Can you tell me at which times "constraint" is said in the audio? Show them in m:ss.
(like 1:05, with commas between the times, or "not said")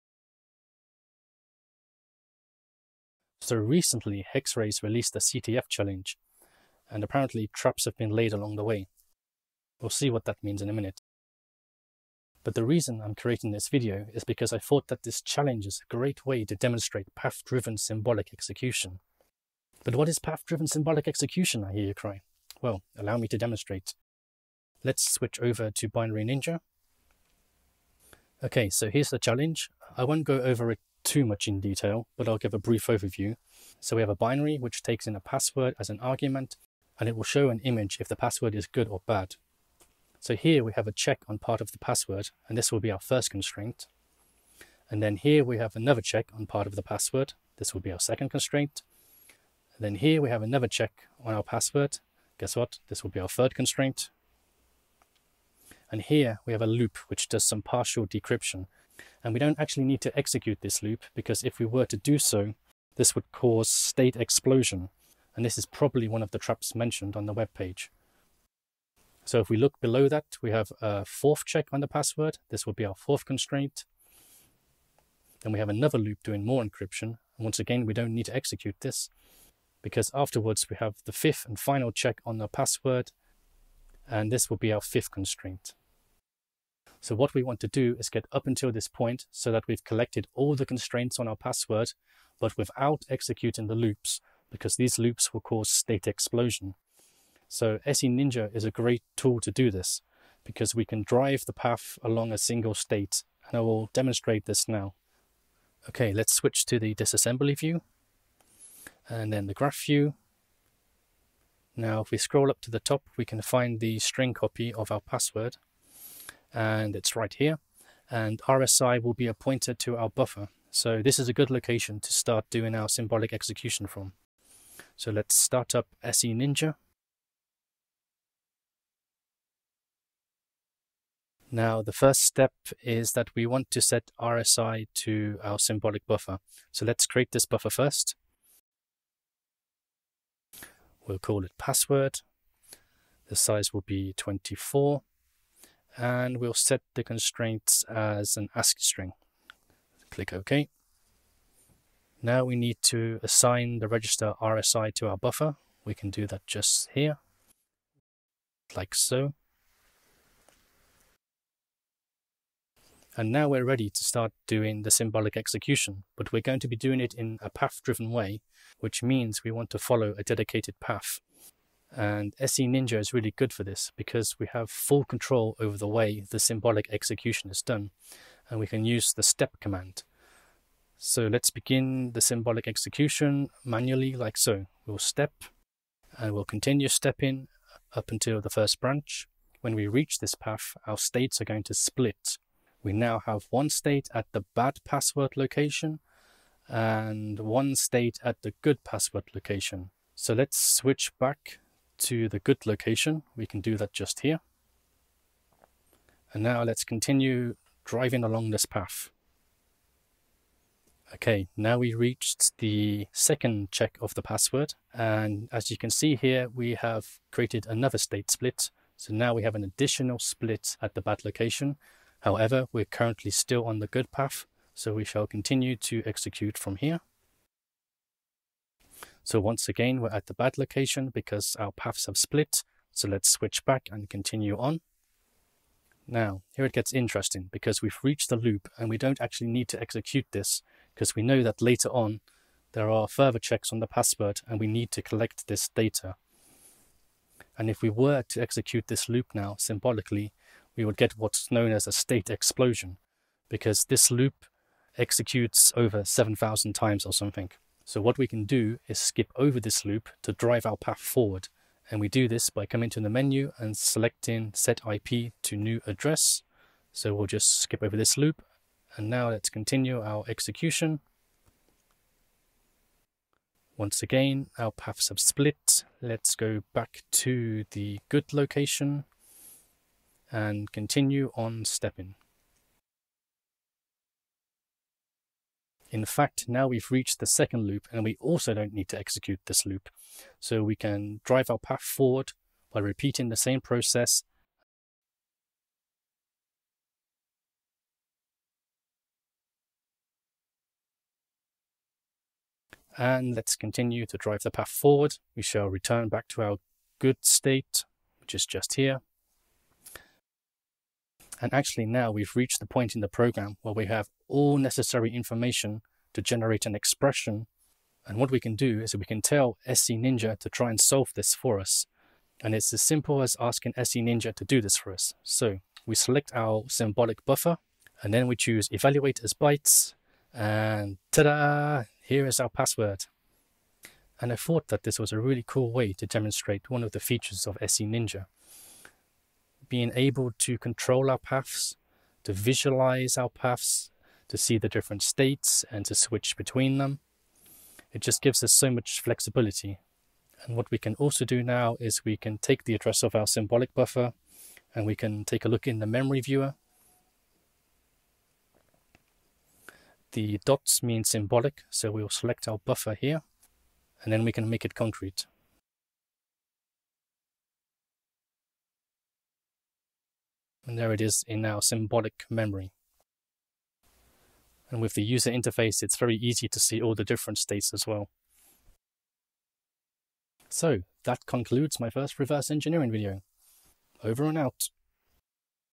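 0:43, 0:48, 0:53, 1:13, 1:25, 1:30, 2:27.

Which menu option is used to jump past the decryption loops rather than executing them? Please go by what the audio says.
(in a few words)
set IP to new address.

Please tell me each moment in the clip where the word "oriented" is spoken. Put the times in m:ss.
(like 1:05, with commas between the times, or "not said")
not said.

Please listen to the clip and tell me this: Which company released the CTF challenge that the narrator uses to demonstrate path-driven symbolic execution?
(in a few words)
Hex-Rays.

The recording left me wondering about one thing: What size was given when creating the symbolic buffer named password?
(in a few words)
24.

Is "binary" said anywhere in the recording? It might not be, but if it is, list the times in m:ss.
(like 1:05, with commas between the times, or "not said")
0:25, 0:34.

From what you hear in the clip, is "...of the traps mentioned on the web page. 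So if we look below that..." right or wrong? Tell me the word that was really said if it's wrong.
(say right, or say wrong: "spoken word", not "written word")
right.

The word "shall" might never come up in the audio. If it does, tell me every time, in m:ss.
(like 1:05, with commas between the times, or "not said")
3:45, 5:05.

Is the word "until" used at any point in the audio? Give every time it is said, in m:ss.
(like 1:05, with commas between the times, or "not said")
1:28, 3:08.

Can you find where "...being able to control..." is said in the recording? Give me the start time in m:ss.
5:39.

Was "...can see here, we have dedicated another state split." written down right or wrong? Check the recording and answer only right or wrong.
wrong.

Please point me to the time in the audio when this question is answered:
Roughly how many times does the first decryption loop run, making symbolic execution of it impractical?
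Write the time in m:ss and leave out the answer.
4:15.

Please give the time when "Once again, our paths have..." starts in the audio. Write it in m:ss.
4:33.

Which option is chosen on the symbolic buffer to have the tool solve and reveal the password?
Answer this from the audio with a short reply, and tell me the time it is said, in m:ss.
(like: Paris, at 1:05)
evaluate as bytes, at 5:28.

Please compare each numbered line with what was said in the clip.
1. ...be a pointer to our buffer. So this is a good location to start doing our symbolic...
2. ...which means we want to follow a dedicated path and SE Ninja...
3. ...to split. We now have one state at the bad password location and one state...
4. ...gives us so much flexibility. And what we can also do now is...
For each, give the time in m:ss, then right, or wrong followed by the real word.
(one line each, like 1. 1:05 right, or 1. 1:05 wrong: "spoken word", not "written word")
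1. 1:59 right
2. 2:48 right
3. 3:11 right
4. 5:48 right.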